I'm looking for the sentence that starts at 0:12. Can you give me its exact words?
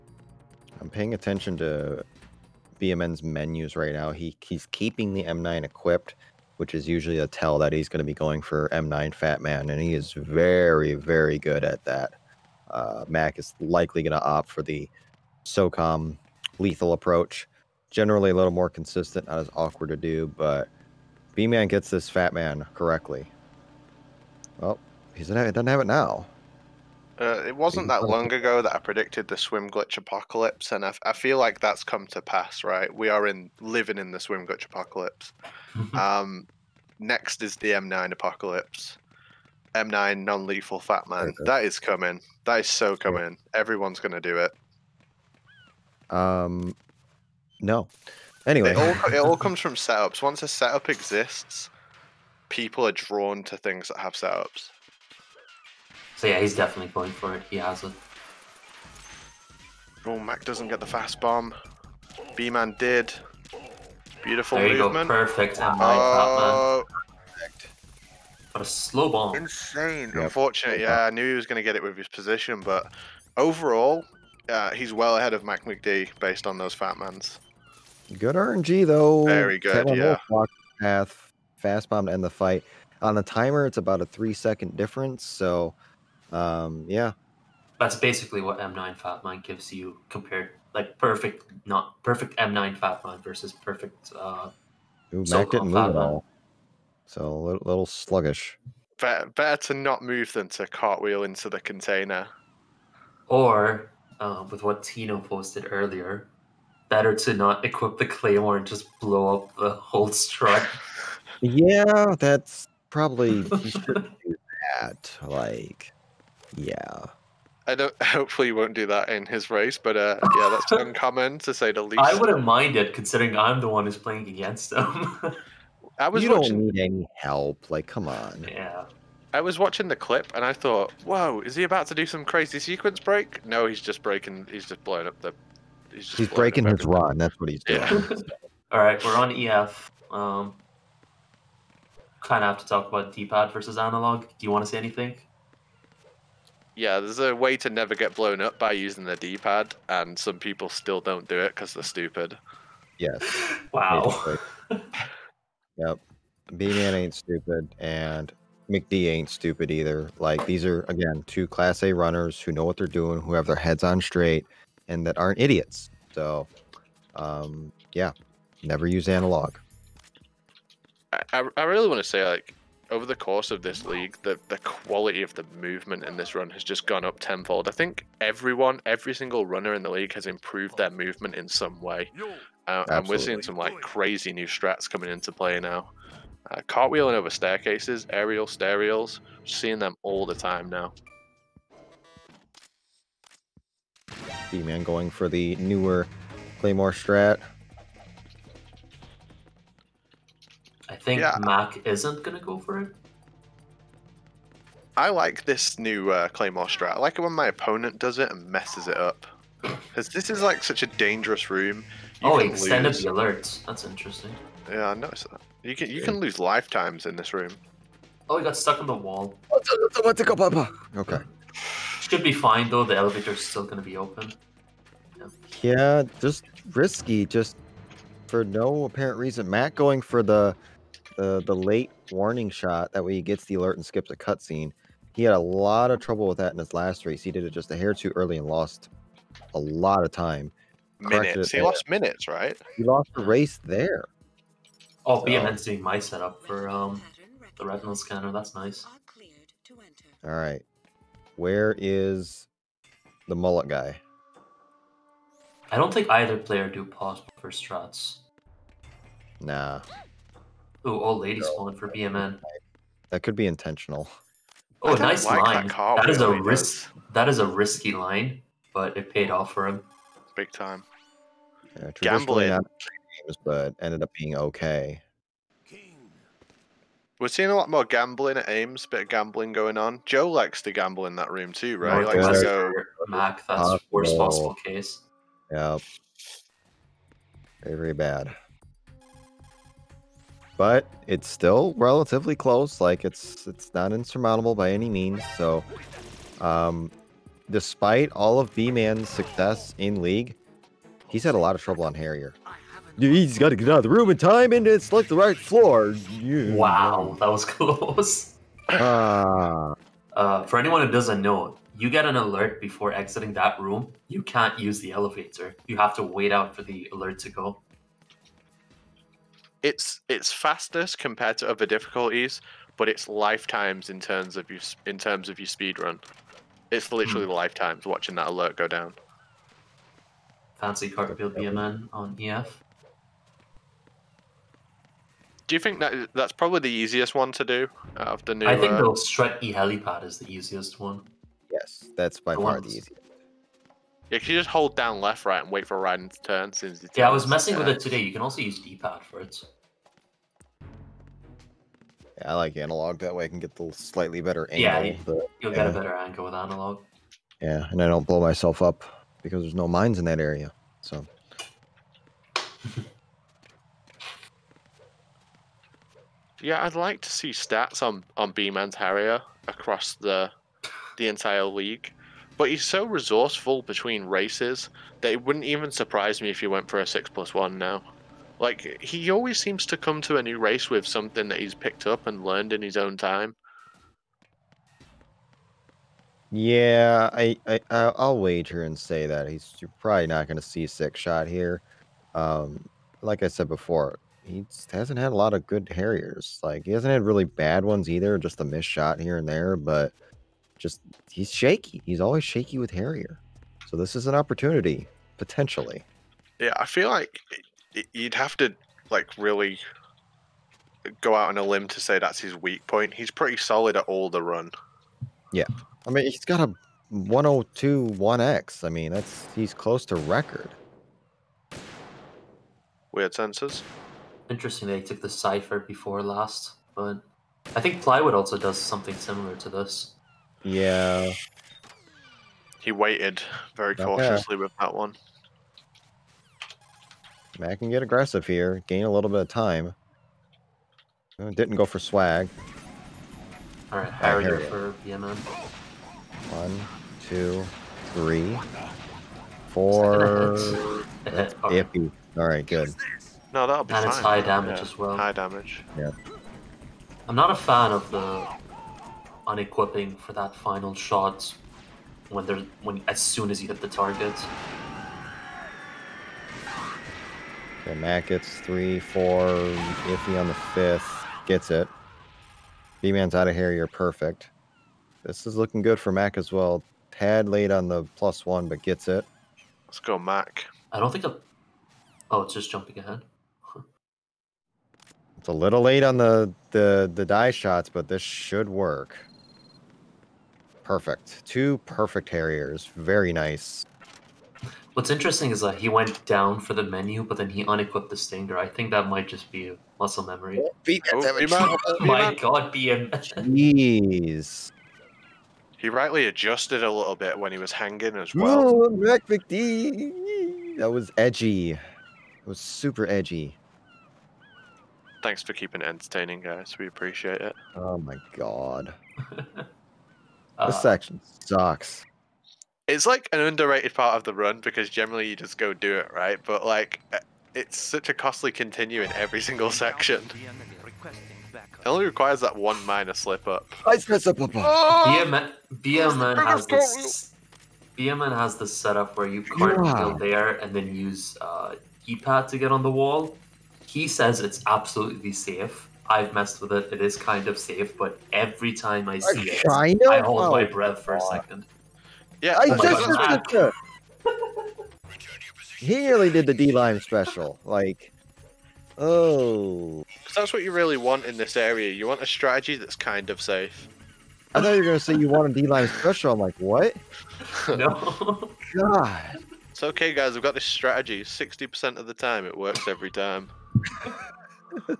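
Uh, Mac is likely going to opt for the SOCOM lethal approach.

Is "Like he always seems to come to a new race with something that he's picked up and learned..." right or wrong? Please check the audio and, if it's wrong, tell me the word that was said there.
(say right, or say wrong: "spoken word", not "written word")
right.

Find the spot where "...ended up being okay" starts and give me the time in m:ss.
4:33.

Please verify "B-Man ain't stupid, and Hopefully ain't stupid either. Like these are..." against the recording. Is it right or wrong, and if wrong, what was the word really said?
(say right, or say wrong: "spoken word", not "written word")
wrong: "McD", not "Hopefully".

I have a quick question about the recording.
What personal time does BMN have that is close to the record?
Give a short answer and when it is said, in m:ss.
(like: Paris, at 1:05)
102, at 6:56.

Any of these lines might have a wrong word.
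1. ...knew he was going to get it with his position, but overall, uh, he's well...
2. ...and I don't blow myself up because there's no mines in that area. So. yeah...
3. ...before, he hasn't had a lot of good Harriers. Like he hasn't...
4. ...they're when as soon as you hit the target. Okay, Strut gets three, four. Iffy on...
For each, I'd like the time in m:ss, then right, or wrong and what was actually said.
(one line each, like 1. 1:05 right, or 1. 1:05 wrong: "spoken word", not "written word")
1. 1:11 right
2. 5:57 right
3. 6:33 right
4. 7:42 wrong: "Matt", not "Strut".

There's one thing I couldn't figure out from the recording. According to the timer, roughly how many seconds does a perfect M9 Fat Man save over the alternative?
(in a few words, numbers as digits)
3 seconds.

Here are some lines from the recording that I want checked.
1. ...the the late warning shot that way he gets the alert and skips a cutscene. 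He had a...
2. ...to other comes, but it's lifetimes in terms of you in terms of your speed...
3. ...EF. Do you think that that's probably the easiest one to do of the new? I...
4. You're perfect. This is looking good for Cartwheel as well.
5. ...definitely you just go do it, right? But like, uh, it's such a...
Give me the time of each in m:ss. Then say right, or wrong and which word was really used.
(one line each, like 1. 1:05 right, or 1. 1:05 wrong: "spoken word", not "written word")
1. 3:51 right
2. 5:21 wrong: "difficulties", not "comes"
3. 5:32 right
4. 7:53 wrong: "Mac", not "Cartwheel"
5. 8:44 wrong: "generally", not "definitely".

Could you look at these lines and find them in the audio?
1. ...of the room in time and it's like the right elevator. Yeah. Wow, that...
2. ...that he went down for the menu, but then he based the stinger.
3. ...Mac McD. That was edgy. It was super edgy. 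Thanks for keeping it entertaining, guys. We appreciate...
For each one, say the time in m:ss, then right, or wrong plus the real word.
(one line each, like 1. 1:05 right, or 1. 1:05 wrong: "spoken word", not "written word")
1. 5:03 wrong: "floor", not "elevator"
2. 8:15 wrong: "unequipped", not "based"
3. 8:28 right.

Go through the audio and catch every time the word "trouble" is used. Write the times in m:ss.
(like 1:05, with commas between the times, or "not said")
3:55, 5:01.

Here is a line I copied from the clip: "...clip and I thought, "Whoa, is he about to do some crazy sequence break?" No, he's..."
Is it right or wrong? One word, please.
right.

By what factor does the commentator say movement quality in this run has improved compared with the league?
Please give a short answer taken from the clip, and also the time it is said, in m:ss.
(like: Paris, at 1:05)
tenfold, at 2:57.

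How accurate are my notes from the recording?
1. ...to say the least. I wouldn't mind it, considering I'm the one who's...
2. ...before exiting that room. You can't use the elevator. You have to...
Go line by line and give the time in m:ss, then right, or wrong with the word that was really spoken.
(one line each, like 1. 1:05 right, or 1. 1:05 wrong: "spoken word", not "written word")
1. 2:01 right
2. 5:12 right.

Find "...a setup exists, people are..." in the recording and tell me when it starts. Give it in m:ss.
0:50.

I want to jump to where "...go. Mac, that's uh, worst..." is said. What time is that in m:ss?
4:42.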